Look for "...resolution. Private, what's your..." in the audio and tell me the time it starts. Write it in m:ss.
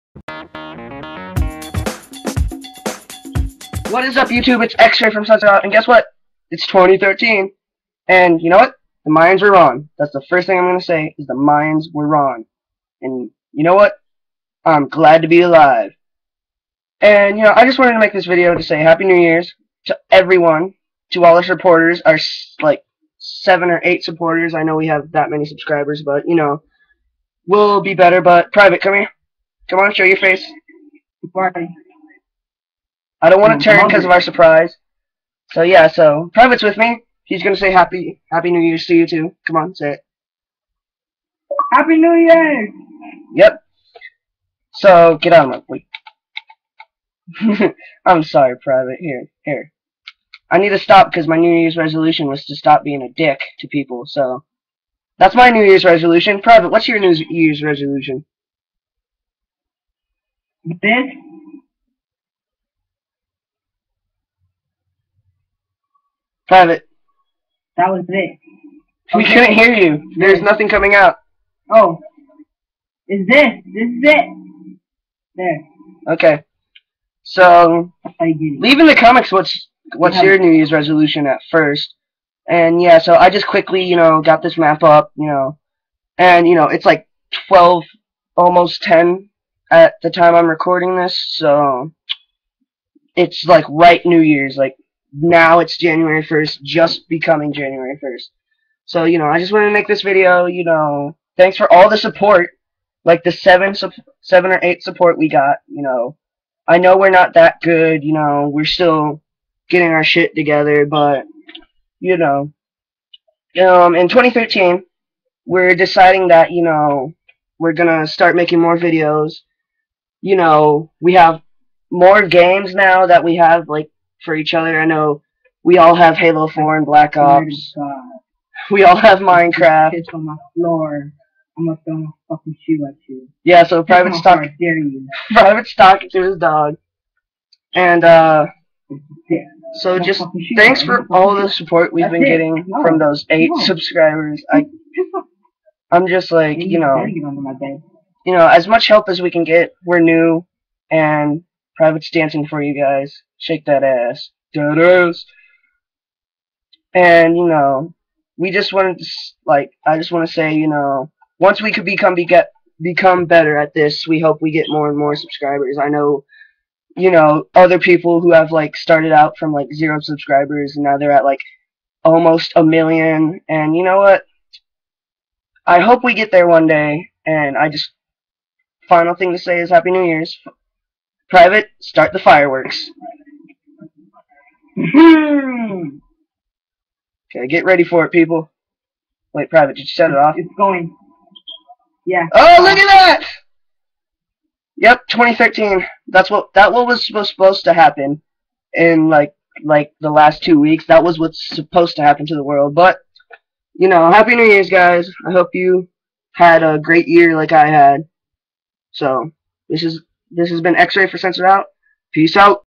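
0:55.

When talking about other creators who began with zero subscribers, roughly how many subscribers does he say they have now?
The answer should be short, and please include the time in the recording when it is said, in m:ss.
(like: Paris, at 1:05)
almost a million, at 2:52.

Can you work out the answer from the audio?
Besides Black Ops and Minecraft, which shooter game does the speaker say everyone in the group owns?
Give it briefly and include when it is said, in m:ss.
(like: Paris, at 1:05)
Halo 4, at 2:06.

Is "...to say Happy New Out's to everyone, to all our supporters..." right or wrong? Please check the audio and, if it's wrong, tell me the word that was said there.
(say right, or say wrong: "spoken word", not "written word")
wrong: "Year", not "Out".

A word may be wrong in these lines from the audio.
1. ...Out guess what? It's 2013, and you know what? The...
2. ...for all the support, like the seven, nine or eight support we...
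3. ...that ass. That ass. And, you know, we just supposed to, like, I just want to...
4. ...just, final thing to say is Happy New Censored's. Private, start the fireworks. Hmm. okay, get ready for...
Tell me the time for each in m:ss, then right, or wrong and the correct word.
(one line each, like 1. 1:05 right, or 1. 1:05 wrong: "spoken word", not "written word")
1. 0:05 right
2. 1:41 wrong: "seven", not "nine"
3. 2:33 wrong: "wanted", not "supposed"
4. 2:57 wrong: "Year", not "Censored".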